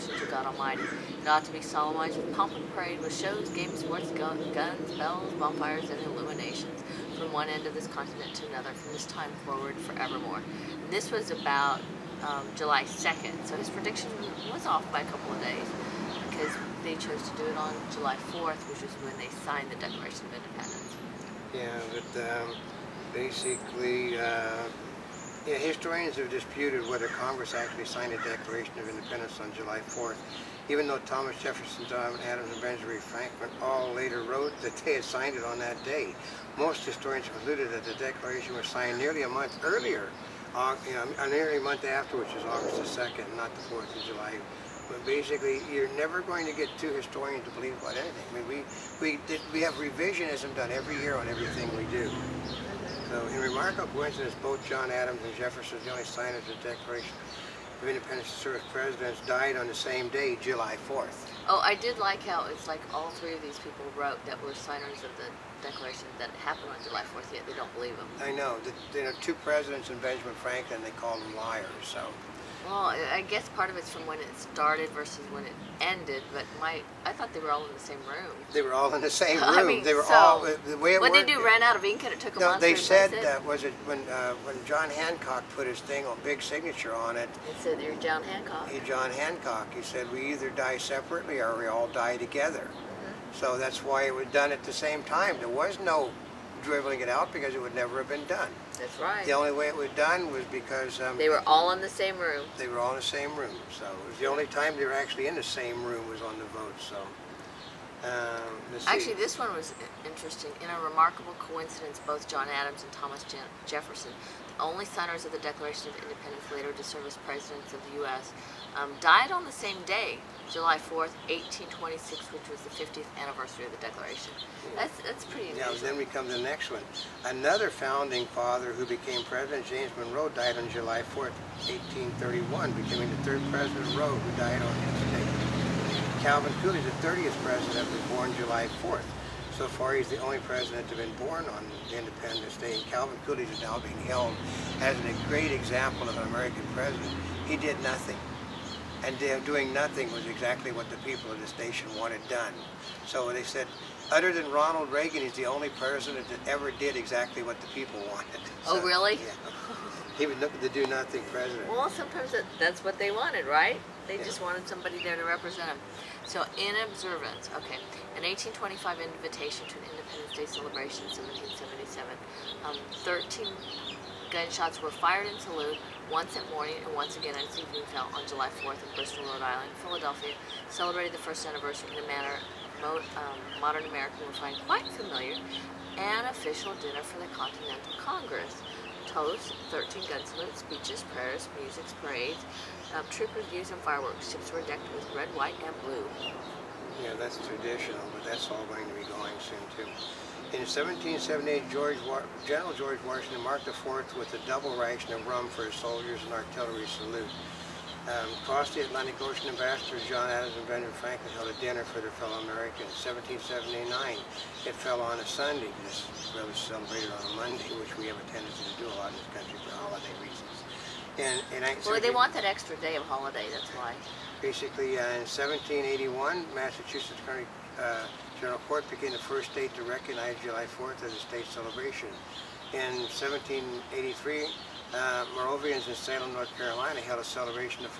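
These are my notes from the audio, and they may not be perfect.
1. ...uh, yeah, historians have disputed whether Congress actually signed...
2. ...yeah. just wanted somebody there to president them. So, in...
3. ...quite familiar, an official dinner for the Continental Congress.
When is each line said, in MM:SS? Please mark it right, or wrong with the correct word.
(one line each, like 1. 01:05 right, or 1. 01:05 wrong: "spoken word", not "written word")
1. 00:24 right
2. 02:44 wrong: "represent", not "president"
3. 03:04 right.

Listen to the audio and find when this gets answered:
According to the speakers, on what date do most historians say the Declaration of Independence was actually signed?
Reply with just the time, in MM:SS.
00:42.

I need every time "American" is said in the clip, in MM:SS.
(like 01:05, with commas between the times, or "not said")
02:26, 03:03, 03:32.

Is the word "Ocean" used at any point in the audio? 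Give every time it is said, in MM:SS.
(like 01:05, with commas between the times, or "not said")
03:29.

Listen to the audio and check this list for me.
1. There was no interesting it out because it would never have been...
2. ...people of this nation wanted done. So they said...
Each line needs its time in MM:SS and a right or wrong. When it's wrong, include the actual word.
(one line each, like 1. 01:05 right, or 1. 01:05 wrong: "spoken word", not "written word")
1. 01:35 wrong: "dribbling", not "interesting"
2. 02:30 right.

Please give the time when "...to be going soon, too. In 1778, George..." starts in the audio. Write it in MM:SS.
03:18.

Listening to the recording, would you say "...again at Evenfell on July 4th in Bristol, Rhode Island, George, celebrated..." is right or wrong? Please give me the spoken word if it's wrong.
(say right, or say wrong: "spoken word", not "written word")
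wrong: "Philadelphia", not "George".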